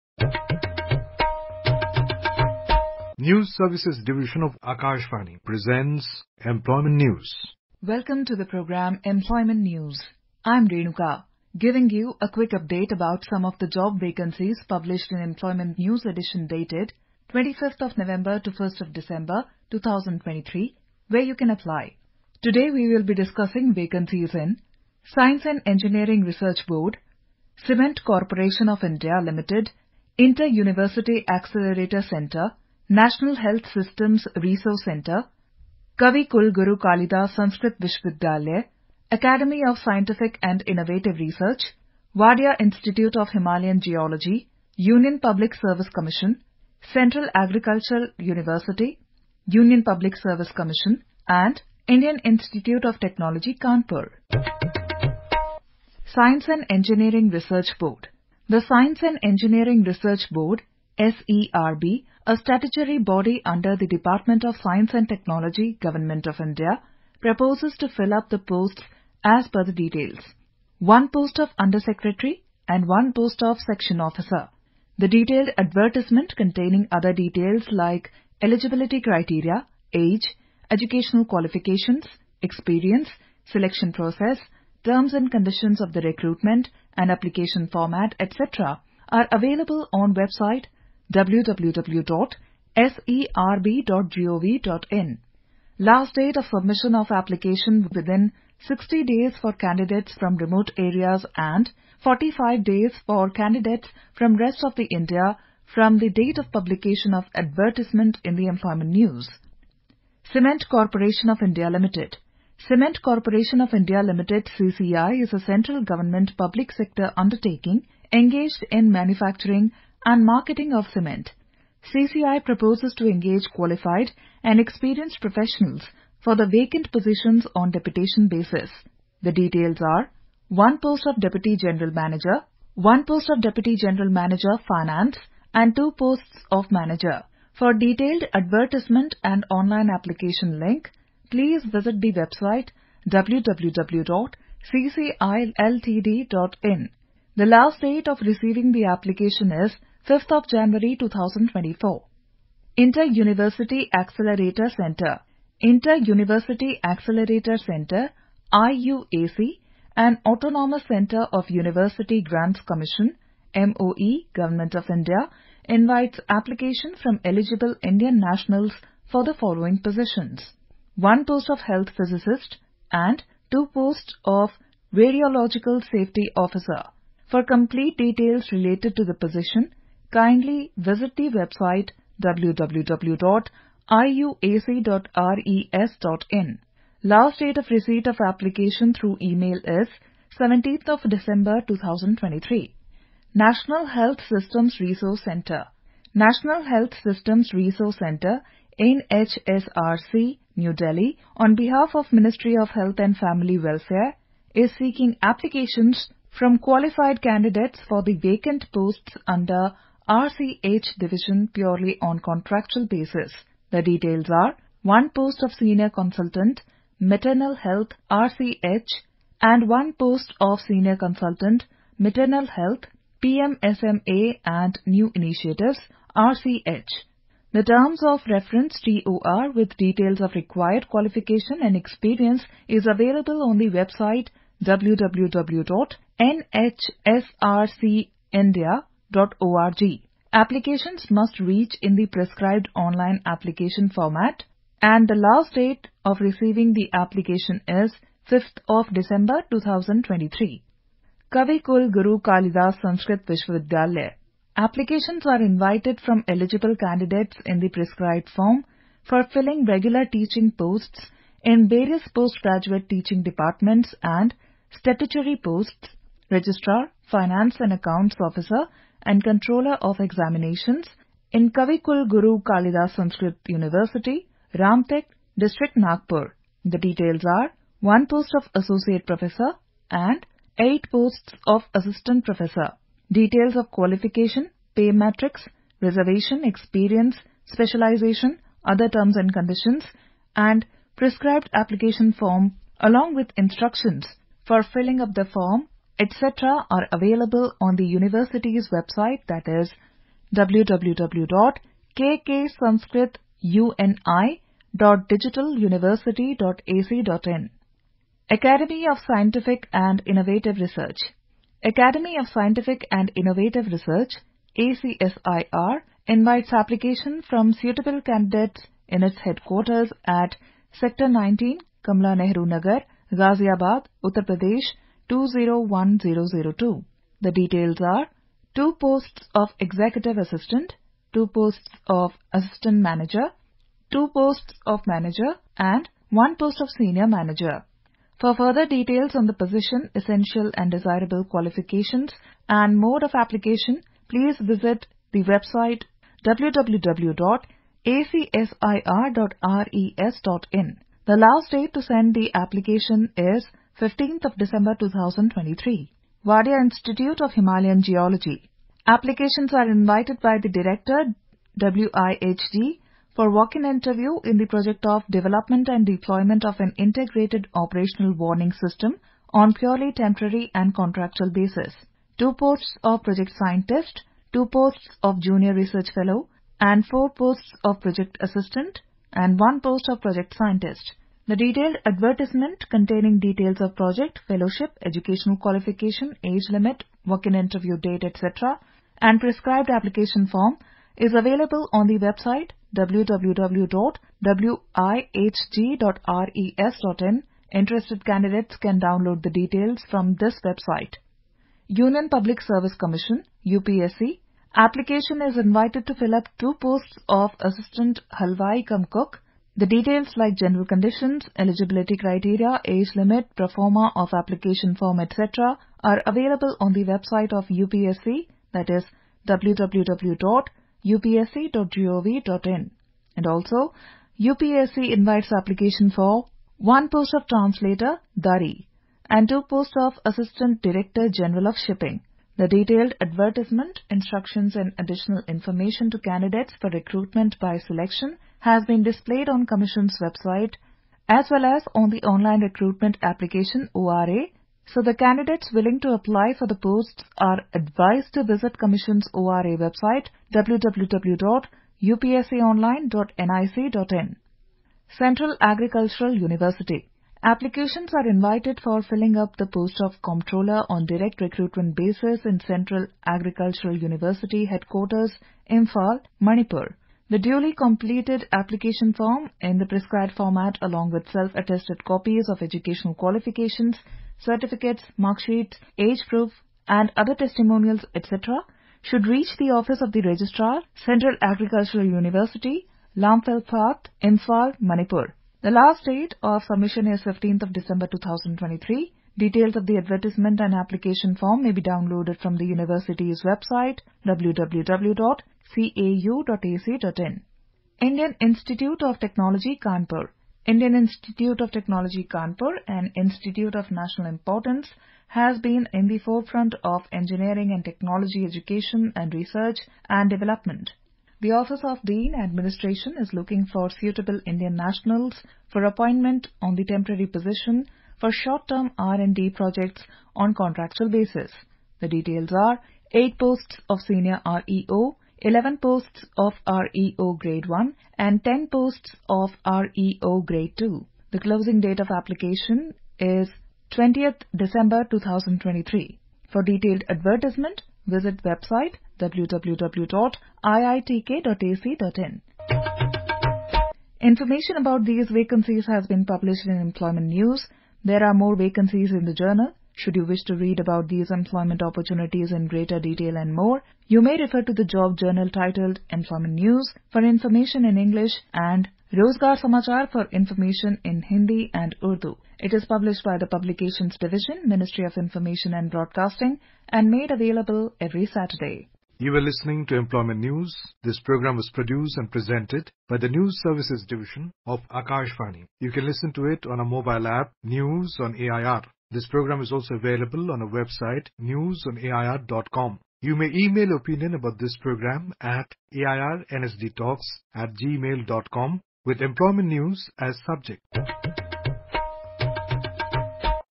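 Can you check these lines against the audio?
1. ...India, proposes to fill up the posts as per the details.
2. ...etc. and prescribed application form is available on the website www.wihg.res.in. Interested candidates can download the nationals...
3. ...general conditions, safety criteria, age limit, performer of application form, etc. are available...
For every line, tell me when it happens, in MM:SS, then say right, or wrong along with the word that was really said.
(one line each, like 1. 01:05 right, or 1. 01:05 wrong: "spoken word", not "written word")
1. 01:06 right
2. 06:28 wrong: "details", not "nationals"
3. 06:50 wrong: "eligibility", not "safety".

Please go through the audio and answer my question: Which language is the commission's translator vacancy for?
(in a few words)
Dari.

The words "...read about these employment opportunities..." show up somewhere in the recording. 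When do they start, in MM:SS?
09:10.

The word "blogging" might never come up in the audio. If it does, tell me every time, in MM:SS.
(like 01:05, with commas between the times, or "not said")
not said.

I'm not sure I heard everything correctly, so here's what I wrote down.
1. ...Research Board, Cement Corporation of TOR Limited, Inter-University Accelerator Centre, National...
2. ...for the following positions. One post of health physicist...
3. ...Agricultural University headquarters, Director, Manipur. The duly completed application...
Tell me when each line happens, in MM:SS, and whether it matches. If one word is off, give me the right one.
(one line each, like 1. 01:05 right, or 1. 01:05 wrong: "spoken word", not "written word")
1. 00:26 wrong: "India", not "TOR"
2. 02:49 right
3. 07:43 wrong: "Imphal", not "Director".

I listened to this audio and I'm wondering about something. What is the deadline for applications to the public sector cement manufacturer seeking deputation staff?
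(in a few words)
5 January 2024.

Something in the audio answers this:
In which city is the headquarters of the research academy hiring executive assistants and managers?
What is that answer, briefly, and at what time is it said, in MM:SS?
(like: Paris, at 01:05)
Ghaziabad, at 05:23.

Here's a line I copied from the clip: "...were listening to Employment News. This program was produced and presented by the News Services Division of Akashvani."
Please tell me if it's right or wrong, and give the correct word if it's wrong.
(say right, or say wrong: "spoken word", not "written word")
right.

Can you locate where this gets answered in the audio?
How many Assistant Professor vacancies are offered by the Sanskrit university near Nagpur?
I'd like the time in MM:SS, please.
04:40.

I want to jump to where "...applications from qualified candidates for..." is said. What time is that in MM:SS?
03:25.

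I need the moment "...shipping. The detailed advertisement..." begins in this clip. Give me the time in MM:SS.
07:11.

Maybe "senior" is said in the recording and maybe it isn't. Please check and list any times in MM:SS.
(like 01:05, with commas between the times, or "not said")
03:35, 03:40, 05:36, 08:43.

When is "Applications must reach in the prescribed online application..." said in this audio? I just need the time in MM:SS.
04:00.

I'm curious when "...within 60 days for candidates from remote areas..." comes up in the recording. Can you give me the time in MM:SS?
01:37.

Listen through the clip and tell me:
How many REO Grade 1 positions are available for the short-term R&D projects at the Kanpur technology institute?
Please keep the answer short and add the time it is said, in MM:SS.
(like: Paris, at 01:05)
11, at 08:45.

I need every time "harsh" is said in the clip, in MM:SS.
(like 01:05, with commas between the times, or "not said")
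not said.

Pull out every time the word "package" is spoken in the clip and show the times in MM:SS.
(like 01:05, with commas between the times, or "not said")
not said.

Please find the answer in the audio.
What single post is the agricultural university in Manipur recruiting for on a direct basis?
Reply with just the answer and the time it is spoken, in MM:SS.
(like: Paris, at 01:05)
Comptroller, at 07:40.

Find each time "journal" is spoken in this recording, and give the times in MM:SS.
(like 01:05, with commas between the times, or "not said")
09:09, 09:14.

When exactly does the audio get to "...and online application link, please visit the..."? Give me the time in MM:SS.
02:19.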